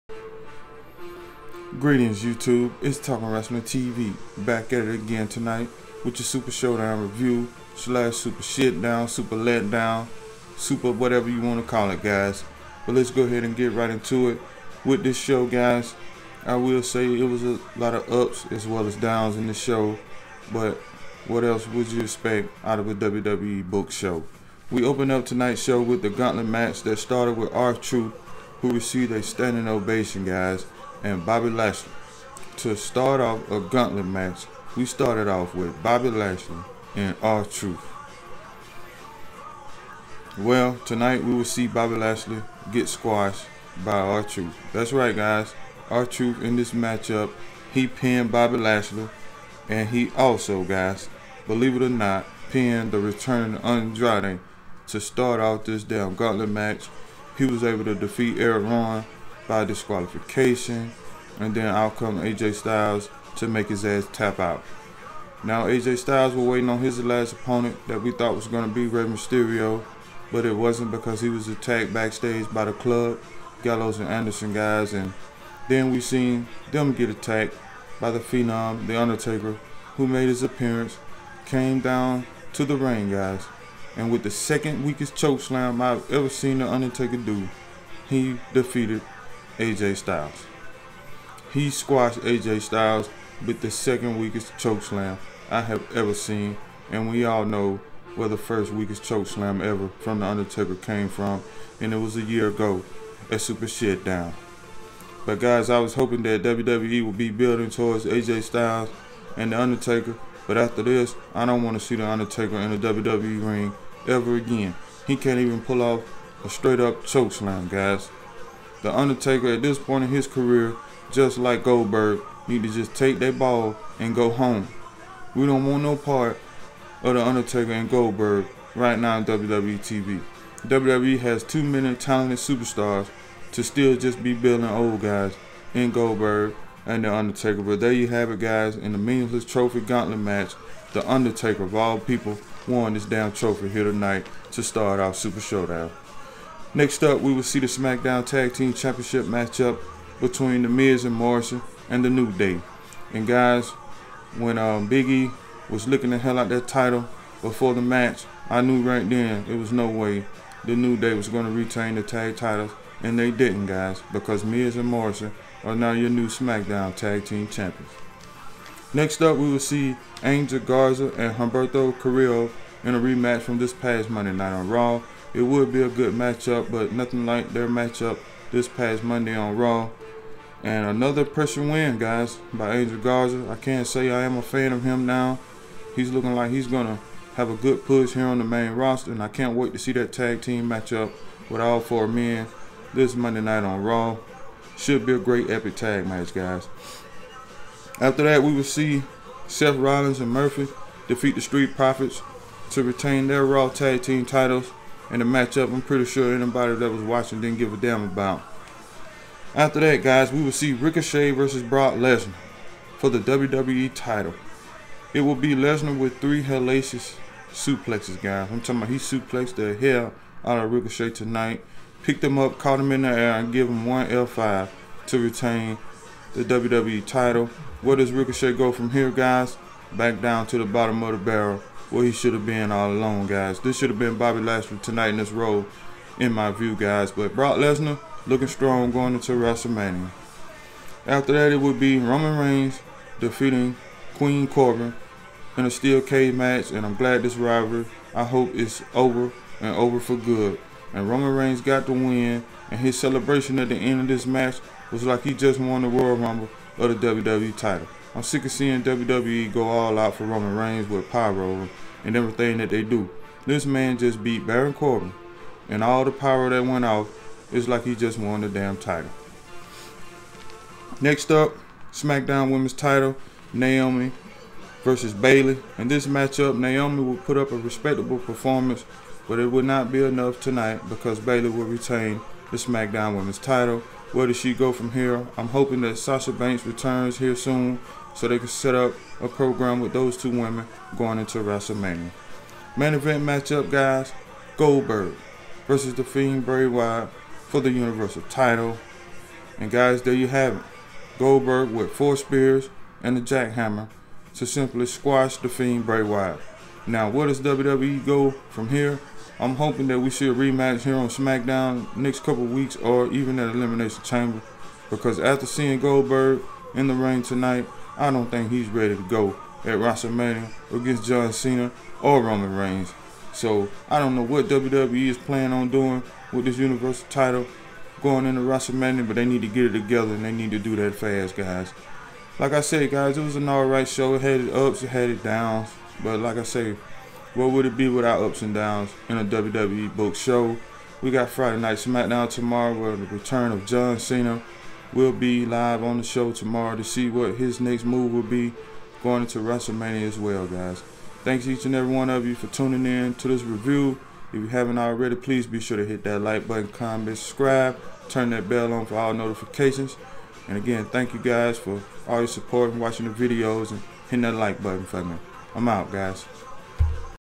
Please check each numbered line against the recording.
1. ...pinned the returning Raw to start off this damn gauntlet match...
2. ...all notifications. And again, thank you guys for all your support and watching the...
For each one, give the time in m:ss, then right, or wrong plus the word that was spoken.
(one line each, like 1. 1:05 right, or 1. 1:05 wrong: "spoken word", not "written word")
1. 0:52 wrong: "Andrade", not "Raw"
2. 5:58 right.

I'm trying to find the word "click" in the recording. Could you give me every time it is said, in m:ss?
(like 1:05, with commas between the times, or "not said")
not said.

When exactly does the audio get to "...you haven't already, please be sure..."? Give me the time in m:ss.
5:54.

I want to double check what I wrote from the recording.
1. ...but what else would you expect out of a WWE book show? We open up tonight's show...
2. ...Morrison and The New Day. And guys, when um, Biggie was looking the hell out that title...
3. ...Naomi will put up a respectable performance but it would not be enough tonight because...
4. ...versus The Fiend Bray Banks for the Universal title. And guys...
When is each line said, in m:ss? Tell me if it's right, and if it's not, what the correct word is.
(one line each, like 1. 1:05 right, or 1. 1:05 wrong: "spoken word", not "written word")
1. 0:20 right
2. 2:31 right
3. 4:36 right
4. 4:55 wrong: "Wyatt", not "Banks".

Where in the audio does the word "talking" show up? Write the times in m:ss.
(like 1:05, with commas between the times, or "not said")
0:02, 3:38.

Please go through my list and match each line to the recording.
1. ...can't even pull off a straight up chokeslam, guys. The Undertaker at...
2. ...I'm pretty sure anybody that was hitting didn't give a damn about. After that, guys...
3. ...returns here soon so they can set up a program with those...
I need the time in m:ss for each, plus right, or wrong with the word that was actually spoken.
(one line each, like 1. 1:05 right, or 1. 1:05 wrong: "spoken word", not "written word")
1. 1:55 right
2. 3:25 wrong: "watching", not "hitting"
3. 4:46 right.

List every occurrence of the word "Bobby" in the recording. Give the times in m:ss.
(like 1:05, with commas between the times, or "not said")
0:31, 0:35, 0:41, 0:48, 3:54.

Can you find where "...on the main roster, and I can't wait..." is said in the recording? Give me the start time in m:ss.
3:08.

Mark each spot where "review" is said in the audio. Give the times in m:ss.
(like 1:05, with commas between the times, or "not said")
0:07, 5:53.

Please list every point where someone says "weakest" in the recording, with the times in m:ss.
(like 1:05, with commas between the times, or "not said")
1:24, 1:34, 1:38.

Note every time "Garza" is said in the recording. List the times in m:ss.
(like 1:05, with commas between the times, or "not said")
2:50, 3:02.